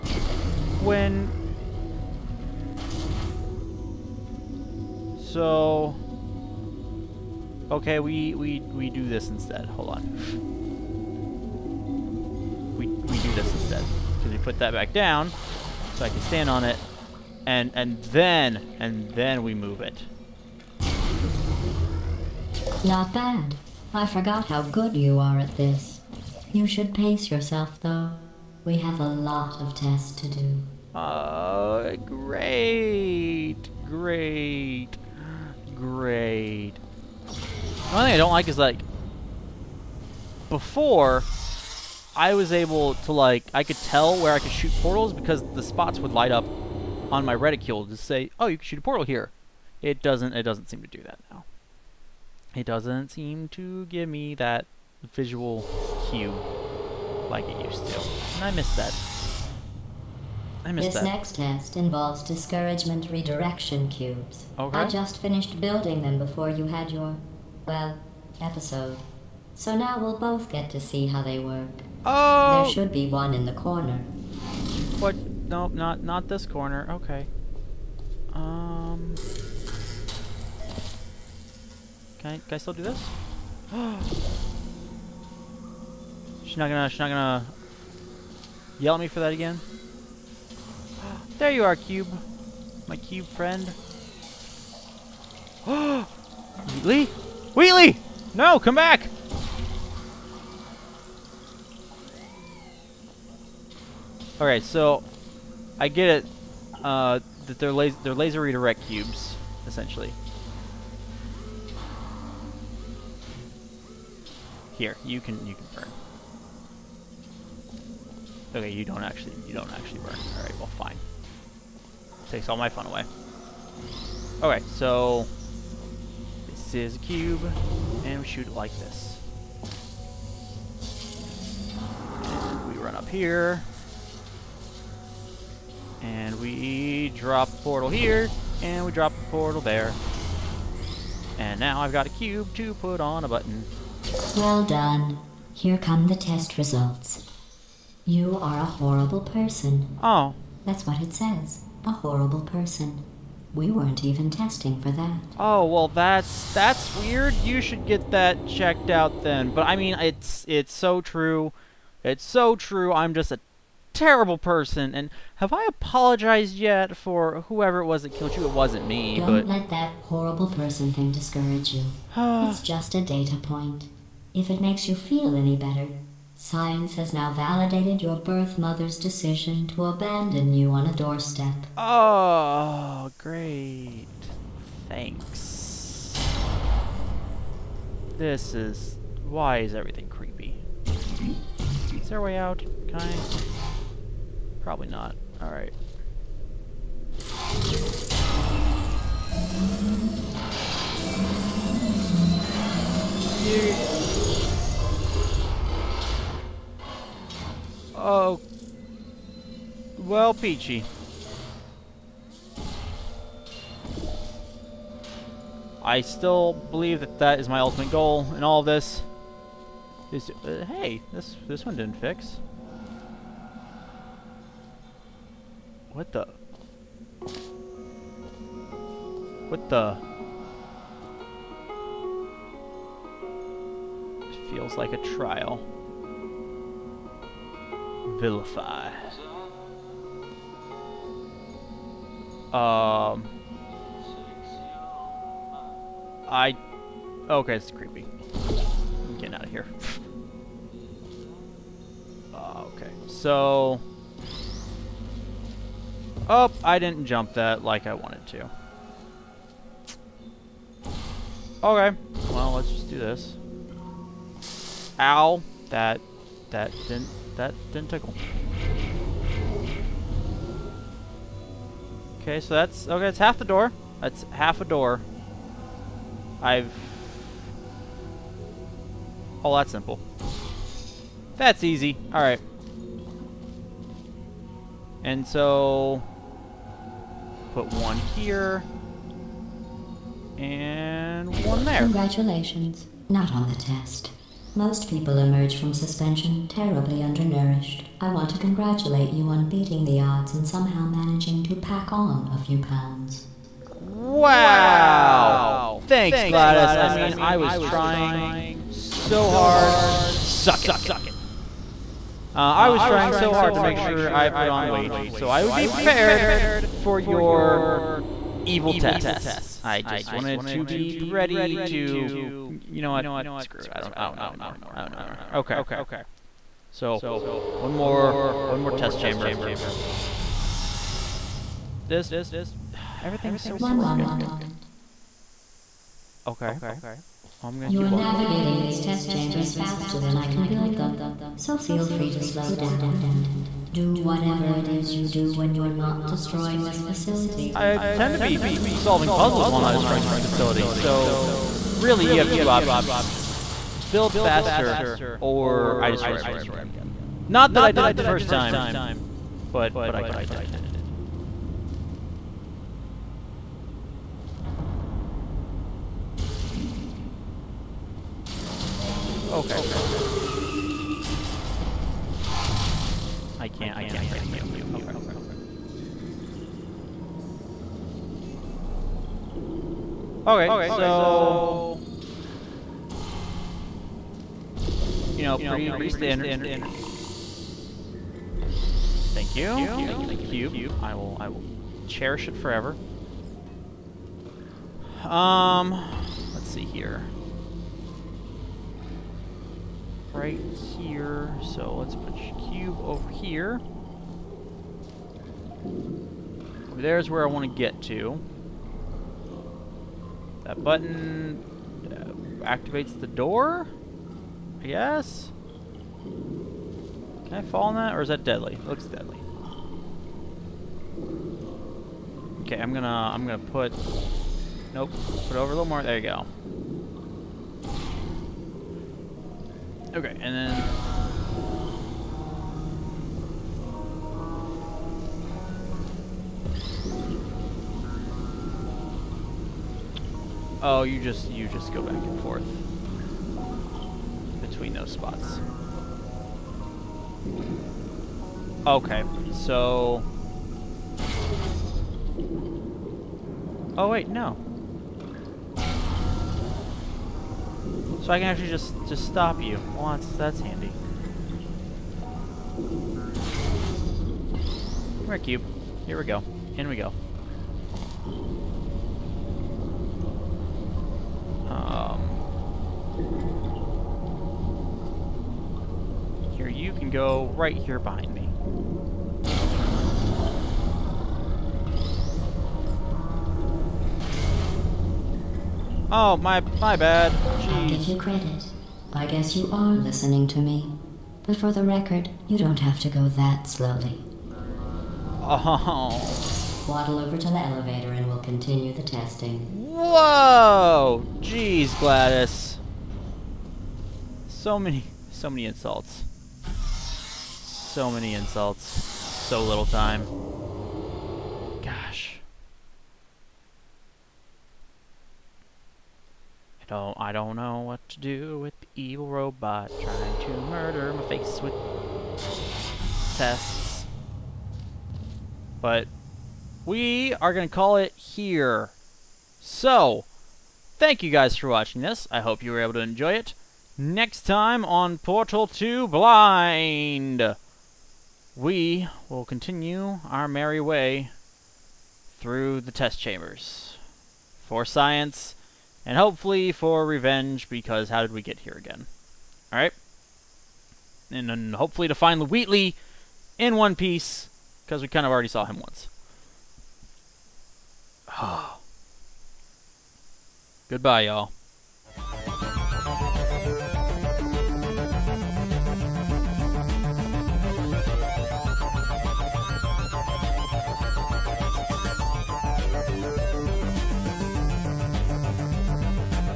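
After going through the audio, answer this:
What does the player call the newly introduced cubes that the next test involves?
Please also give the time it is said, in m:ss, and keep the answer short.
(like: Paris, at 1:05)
Laser redirect cubes, at 1:48.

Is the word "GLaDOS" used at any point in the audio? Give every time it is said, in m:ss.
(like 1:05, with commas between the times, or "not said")
5:06, 8:21.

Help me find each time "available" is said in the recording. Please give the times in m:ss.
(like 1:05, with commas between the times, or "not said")
not said.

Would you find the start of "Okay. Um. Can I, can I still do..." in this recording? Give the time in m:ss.
1:16.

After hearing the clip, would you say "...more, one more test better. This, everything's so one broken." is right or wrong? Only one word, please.
wrong.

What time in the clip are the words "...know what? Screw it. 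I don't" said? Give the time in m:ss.
5:22.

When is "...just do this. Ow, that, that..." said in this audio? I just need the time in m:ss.
4:22.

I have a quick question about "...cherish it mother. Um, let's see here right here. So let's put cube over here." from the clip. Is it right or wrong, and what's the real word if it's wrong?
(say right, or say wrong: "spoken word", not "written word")
wrong: "forever", not "mother".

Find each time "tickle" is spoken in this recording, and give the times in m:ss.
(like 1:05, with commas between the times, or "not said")
4:27.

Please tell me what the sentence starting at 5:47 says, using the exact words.
I tend to be solving puzzles while not destroying this facility, so really you have two options.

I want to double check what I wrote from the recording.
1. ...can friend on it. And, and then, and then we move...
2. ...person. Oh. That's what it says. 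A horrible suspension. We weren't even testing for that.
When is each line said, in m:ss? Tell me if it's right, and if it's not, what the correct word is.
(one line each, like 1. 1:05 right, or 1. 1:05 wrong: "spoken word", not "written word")
1. 0:16 wrong: "stand", not "friend"
2. 2:29 wrong: "person", not "suspension".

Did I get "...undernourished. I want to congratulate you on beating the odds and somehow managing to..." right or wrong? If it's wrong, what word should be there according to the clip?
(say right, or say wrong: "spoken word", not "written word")
right.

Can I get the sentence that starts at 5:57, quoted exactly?
Not that I did it the first time, but, but I kind of did.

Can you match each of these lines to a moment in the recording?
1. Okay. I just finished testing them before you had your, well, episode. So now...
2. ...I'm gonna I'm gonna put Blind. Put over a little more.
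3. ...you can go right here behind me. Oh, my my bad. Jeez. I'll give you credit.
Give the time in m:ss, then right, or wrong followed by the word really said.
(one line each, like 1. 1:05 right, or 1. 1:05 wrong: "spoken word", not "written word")
1. 1:04 wrong: "building", not "testing"
2. 7:02 wrong: "Nope", not "Blind"
3. 7:56 right.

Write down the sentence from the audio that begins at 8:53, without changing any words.
Next time on Portal 2 Blind, we will continue our merry way through the test chambers.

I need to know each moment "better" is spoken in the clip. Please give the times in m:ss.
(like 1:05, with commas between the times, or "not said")
2:55.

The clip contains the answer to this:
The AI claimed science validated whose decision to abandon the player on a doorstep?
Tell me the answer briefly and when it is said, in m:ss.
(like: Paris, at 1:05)
Birth mother's, at 2:58.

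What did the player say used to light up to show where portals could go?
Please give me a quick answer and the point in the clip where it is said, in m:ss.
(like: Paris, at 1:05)
Reticule, at 0:47.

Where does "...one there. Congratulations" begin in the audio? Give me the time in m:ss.
4:51.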